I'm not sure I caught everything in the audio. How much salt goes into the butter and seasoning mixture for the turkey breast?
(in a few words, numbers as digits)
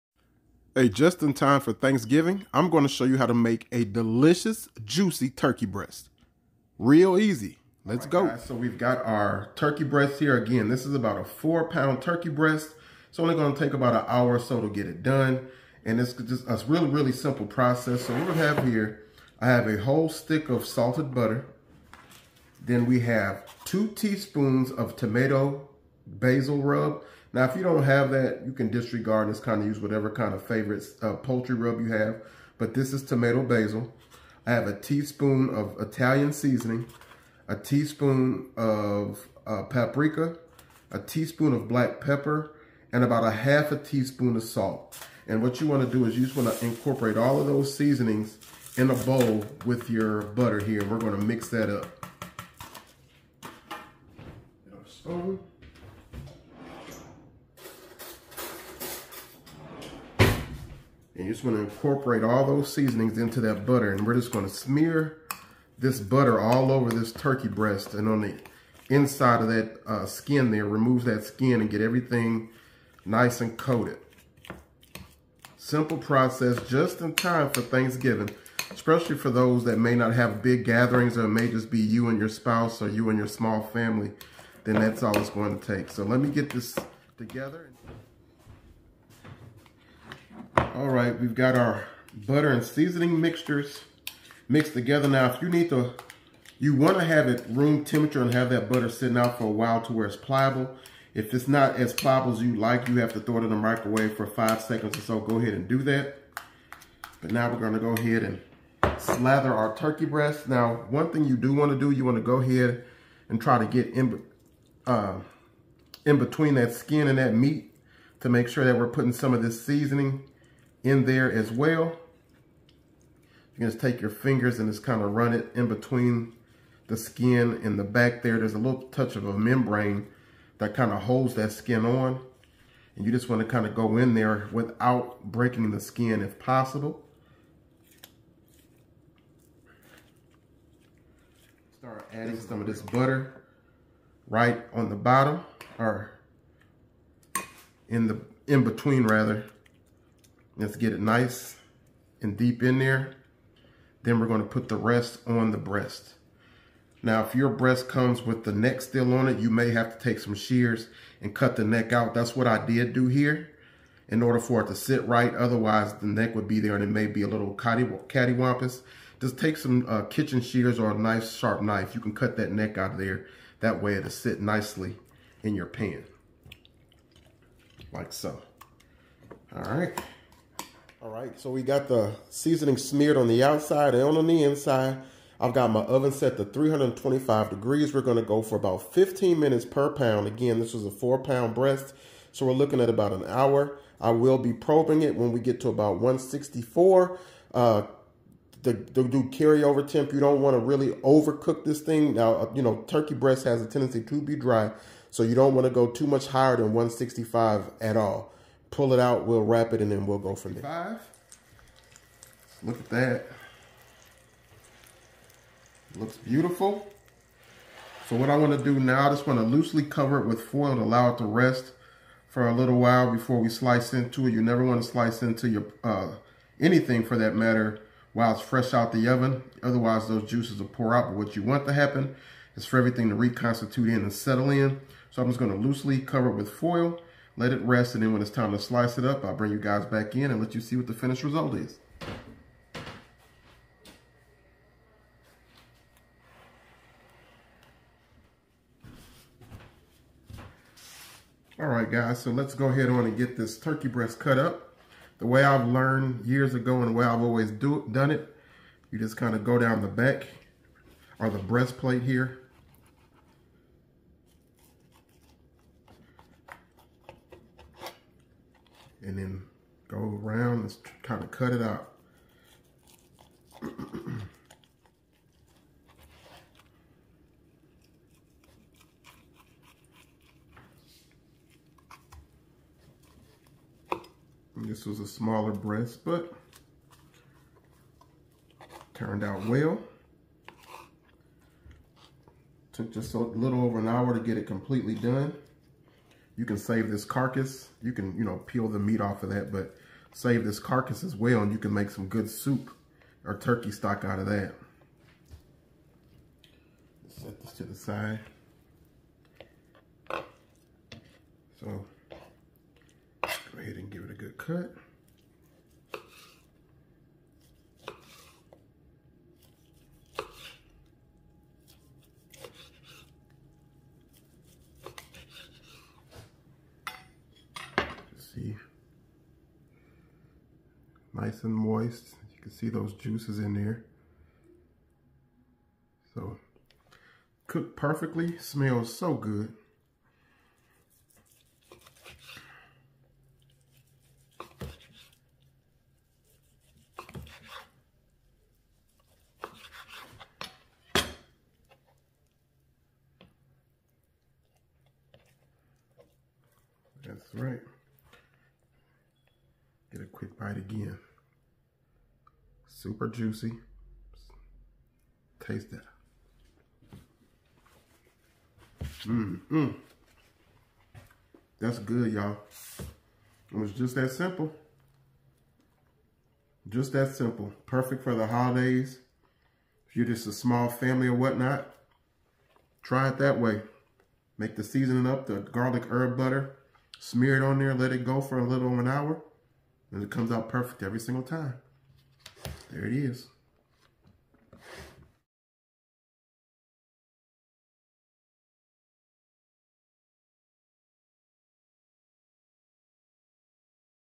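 Half a teaspoon.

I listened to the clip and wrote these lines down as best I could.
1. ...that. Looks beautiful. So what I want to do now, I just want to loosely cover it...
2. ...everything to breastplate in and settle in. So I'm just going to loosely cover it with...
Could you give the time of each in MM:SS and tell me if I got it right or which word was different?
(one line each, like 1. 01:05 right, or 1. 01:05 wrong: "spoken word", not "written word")
1. 03:32 right
2. 03:52 wrong: "reconstitute", not "breastplate".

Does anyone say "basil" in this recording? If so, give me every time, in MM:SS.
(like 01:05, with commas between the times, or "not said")
00:26, 00:33.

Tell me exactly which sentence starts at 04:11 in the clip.
All right, guys, so let's go ahead on and get this turkey breast cut up.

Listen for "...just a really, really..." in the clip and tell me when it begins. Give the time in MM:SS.
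00:16.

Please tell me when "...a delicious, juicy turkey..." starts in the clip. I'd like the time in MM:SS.
00:03.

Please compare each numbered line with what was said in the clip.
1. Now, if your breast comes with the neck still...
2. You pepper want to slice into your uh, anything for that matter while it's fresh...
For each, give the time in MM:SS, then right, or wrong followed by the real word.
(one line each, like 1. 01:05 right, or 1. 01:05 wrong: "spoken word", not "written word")
1. 02:37 right
2. 03:44 wrong: "never", not "pepper".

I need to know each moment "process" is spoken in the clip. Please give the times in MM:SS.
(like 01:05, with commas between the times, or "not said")
00:17, 01:15.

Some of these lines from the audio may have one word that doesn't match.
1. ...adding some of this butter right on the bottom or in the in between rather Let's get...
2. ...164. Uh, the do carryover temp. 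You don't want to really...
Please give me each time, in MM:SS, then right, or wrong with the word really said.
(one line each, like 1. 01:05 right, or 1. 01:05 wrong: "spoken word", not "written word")
1. 02:22 right
2. 03:15 right.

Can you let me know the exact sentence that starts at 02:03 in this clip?
You can just take your fingers and just kind of run it in between the skin in the back there.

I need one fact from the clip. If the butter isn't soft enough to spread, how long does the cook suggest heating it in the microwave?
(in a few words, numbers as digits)
5 seconds.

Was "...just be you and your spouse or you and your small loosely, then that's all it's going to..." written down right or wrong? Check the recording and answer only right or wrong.
wrong.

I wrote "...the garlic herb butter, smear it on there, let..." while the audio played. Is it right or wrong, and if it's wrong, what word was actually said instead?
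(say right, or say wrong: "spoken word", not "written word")
right.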